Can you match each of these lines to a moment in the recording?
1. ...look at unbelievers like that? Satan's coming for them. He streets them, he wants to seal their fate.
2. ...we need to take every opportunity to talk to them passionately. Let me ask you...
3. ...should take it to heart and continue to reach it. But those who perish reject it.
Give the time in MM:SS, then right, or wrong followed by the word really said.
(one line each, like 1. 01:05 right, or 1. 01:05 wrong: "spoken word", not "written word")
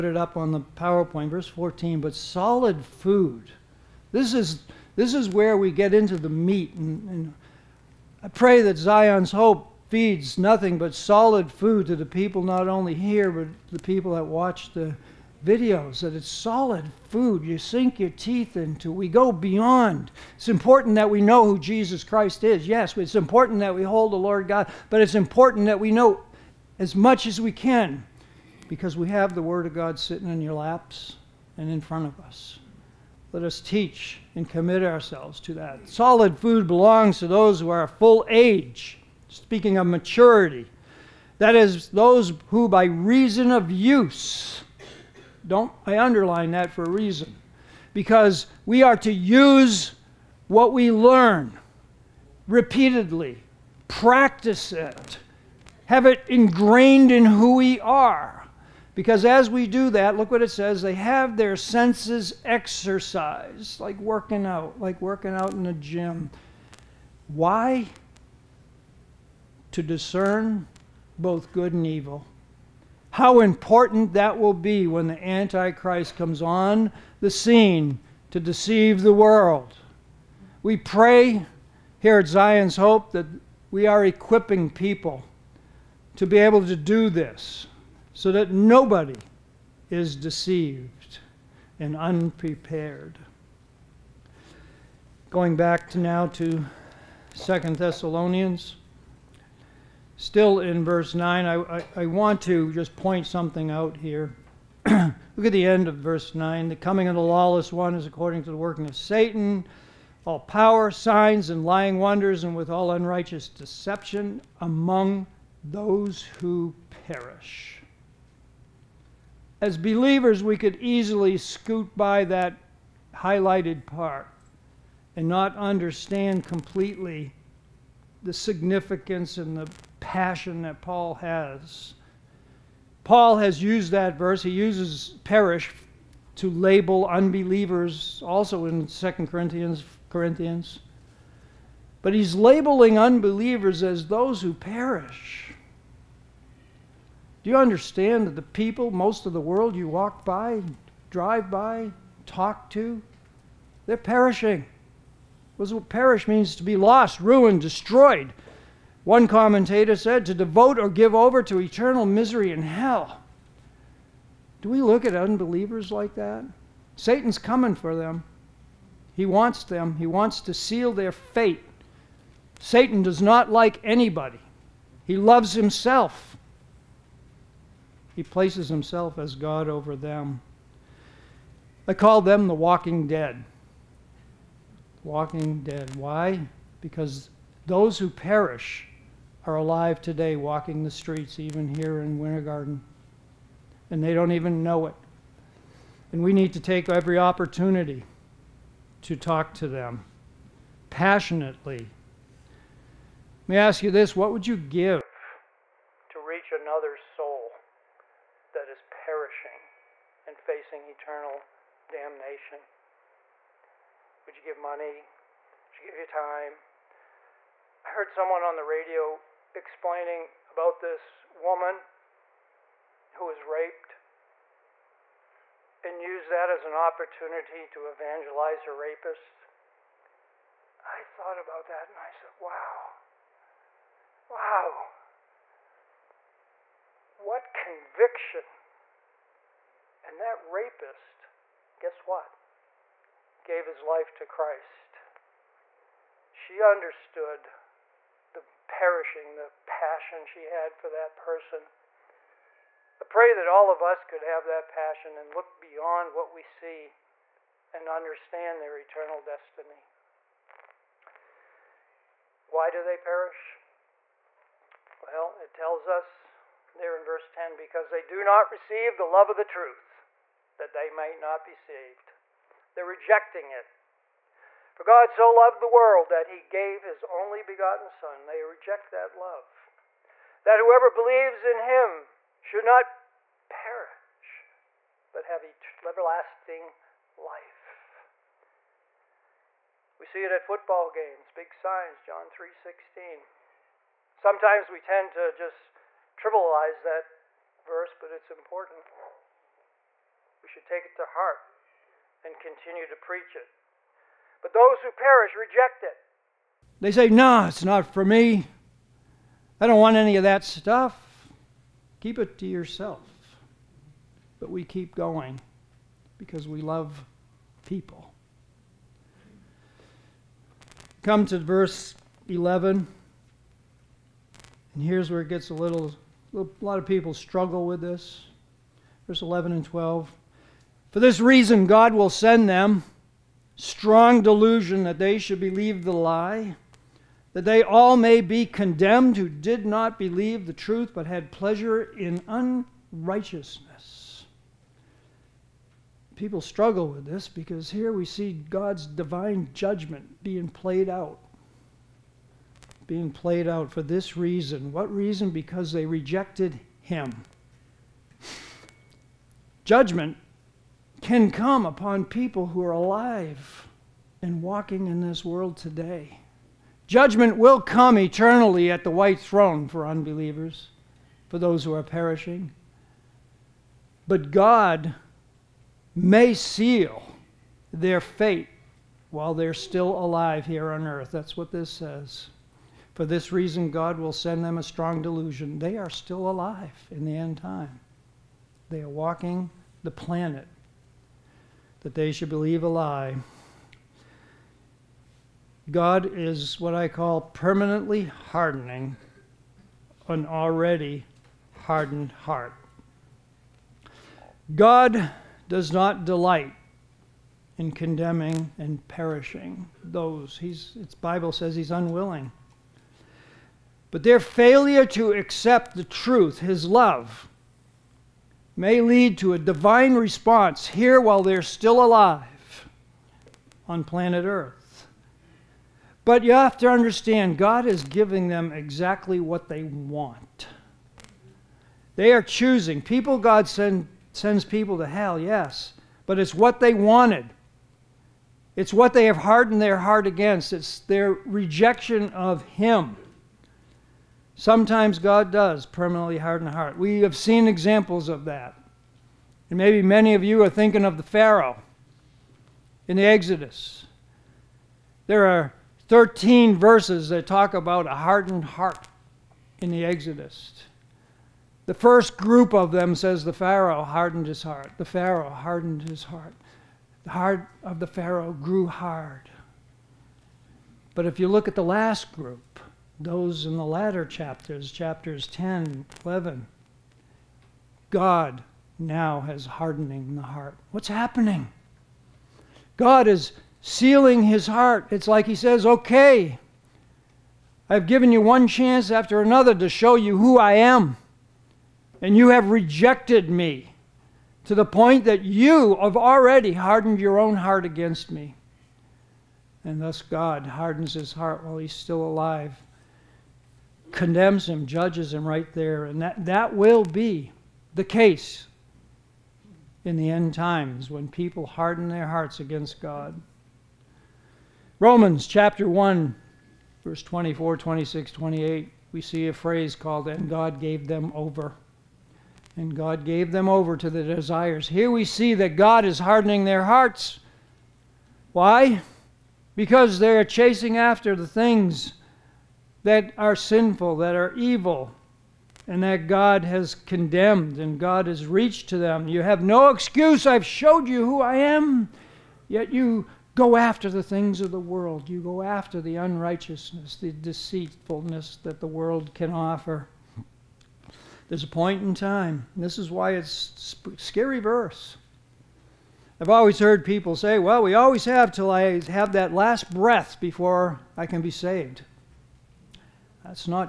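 1. 02:44 wrong: "wants", not "streets"
2. 03:16 right
3. 05:00 wrong: "preach", not "reach".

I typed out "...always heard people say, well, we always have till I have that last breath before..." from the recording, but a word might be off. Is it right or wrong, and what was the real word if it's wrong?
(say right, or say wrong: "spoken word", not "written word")
right.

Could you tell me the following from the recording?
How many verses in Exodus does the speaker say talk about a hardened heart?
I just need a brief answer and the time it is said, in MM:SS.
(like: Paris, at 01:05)
13, at 07:35.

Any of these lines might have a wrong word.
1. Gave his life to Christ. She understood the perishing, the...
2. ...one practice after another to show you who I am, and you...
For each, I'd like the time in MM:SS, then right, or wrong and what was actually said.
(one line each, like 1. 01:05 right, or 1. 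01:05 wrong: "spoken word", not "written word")
1. 04:03 right
2. 08:08 wrong: "chance", not "practice".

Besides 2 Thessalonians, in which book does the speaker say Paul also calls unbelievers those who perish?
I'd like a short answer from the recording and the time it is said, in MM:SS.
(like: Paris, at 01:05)
2 Corinthians, at 02:18.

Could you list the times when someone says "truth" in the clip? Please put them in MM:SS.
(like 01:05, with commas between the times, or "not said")
04:29, 05:40, 06:55.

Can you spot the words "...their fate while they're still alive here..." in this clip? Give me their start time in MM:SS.
06:17.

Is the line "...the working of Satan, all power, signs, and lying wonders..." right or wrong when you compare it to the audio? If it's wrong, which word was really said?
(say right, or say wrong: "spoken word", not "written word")
right.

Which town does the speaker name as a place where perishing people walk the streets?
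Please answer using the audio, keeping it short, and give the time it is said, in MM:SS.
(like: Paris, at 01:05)
Winter Garden, at 03:12.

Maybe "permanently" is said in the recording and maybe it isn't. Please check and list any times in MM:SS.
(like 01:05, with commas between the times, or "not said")
06:37, 07:25.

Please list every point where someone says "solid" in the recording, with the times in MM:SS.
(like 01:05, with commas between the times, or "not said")
00:02, 00:10, 00:16, 00:35.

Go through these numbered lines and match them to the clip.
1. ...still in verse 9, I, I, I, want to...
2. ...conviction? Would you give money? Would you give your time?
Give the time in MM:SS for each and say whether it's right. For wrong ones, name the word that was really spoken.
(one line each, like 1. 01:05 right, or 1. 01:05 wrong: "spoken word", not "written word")
1. 01:40 right
2. 03:31 wrong: "damnation", not "conviction".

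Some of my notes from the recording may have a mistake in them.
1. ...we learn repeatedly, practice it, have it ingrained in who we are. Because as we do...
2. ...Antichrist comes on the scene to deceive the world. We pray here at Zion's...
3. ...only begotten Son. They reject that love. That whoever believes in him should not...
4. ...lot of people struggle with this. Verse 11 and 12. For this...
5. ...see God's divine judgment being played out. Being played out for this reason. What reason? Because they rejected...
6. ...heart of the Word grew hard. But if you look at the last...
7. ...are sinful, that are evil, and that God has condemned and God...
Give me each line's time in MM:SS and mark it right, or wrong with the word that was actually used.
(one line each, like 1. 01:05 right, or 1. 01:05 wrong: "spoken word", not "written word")
1. 00:50 right
2. 01:15 right
3. 04:37 right
4. 05:26 right
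5. 05:48 right
6. 07:47 wrong: "Pharaoh", not "Word"
7. 08:53 right.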